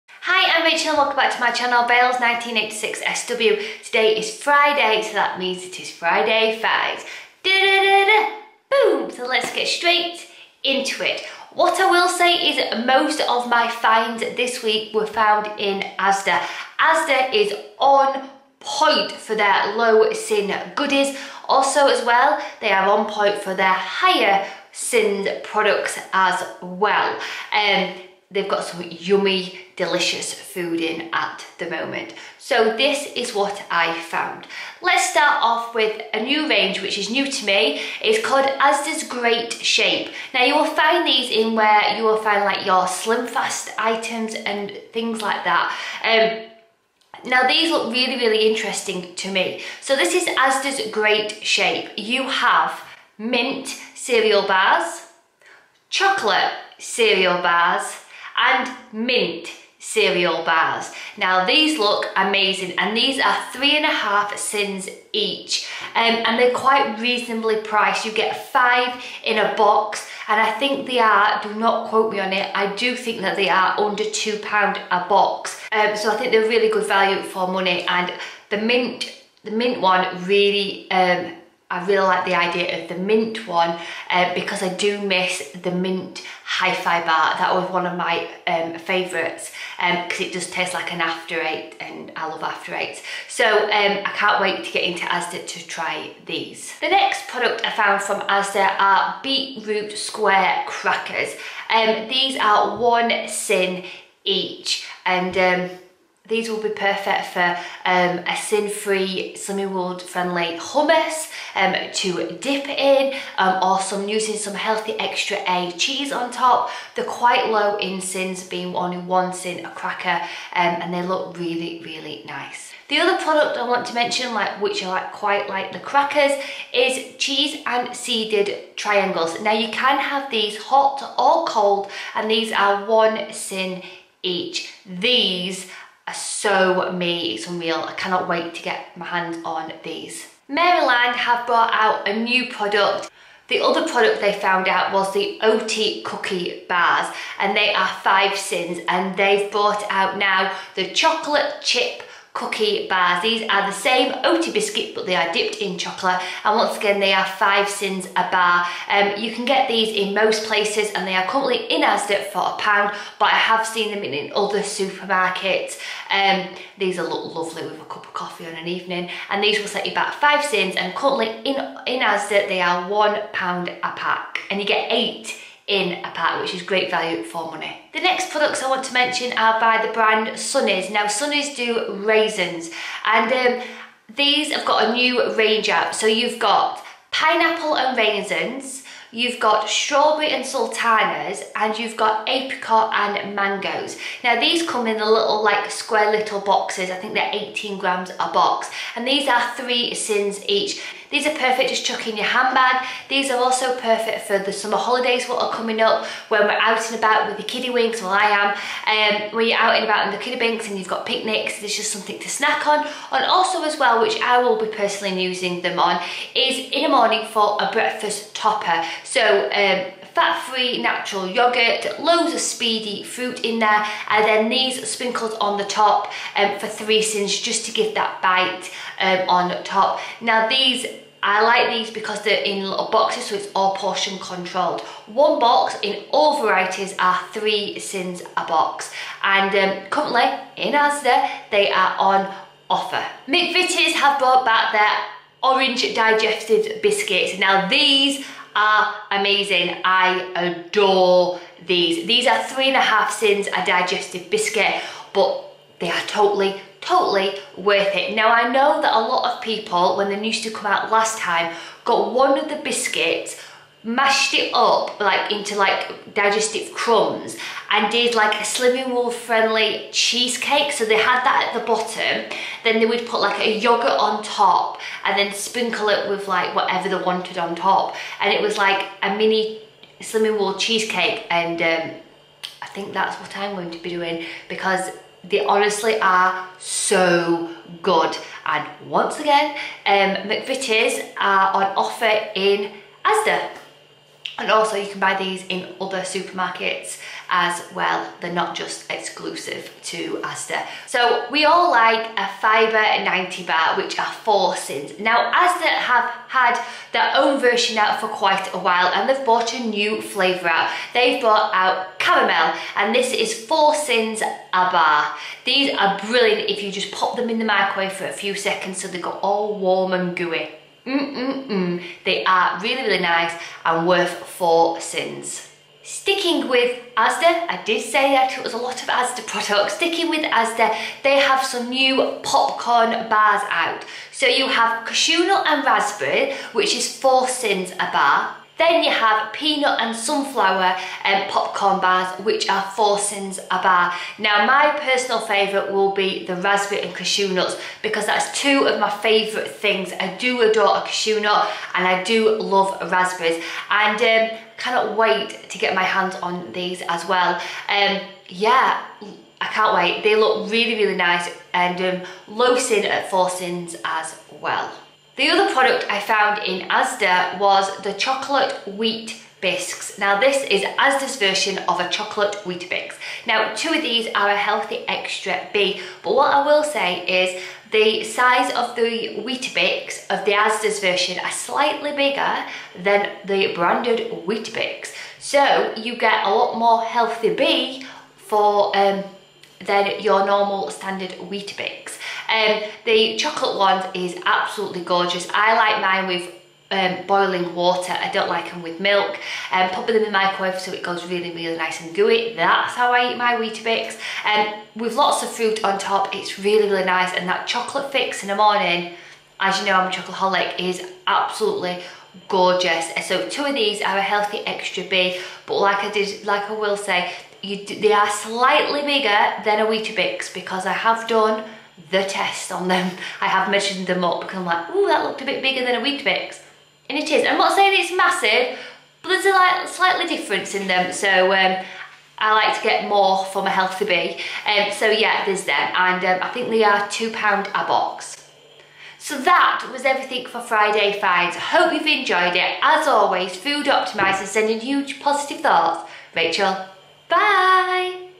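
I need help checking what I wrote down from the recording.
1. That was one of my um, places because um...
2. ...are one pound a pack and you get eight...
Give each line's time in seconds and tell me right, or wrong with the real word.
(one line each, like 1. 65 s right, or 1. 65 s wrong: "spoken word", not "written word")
1. 87 s wrong: "favourites", not "places"
2. 172 s right.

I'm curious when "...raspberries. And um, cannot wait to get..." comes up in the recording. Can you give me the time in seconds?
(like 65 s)
352 s.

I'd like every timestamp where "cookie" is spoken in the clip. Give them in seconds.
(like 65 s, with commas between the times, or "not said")
146 s, 152 s.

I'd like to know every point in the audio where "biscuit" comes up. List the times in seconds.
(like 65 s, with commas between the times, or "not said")
154 s, 246 s, 254 s, 262 s.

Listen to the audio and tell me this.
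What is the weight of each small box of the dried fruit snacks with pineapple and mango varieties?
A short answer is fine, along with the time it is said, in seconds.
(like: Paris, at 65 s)
18 grams, at 197 s.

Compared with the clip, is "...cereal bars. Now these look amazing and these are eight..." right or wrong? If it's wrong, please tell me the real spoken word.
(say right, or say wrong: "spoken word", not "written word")
wrong: "three", not "eight".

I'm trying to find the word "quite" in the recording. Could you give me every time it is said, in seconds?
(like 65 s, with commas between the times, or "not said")
66 s, 117 s, 125 s, 308 s.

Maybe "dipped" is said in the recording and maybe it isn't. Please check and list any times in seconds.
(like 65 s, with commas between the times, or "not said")
155 s.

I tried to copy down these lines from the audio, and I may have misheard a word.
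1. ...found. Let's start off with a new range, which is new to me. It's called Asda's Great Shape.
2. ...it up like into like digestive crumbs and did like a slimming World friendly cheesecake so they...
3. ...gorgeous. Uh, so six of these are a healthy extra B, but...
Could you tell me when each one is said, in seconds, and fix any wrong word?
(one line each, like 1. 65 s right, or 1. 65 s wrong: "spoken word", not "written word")
1. 34 s right
2. 264 s right
3. 412 s wrong: "two", not "six".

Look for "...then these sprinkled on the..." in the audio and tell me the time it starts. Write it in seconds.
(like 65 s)
224 s.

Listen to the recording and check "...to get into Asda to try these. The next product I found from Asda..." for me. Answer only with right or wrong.
right.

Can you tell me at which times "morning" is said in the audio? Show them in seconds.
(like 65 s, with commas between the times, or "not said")
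216 s, 408 s.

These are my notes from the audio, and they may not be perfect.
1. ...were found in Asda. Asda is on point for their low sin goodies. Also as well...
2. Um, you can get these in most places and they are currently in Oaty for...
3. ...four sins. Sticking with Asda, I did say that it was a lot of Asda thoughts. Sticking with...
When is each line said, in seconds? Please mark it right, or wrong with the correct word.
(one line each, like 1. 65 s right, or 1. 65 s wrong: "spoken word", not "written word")
1. 14 s right
2. 158 s wrong: "Asda", not "Oaty"
3. 324 s wrong: "products", not "thoughts".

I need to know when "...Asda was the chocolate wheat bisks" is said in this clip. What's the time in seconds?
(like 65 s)
366 s.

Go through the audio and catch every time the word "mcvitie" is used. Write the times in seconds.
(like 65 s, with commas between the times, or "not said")
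243 s, 290 s.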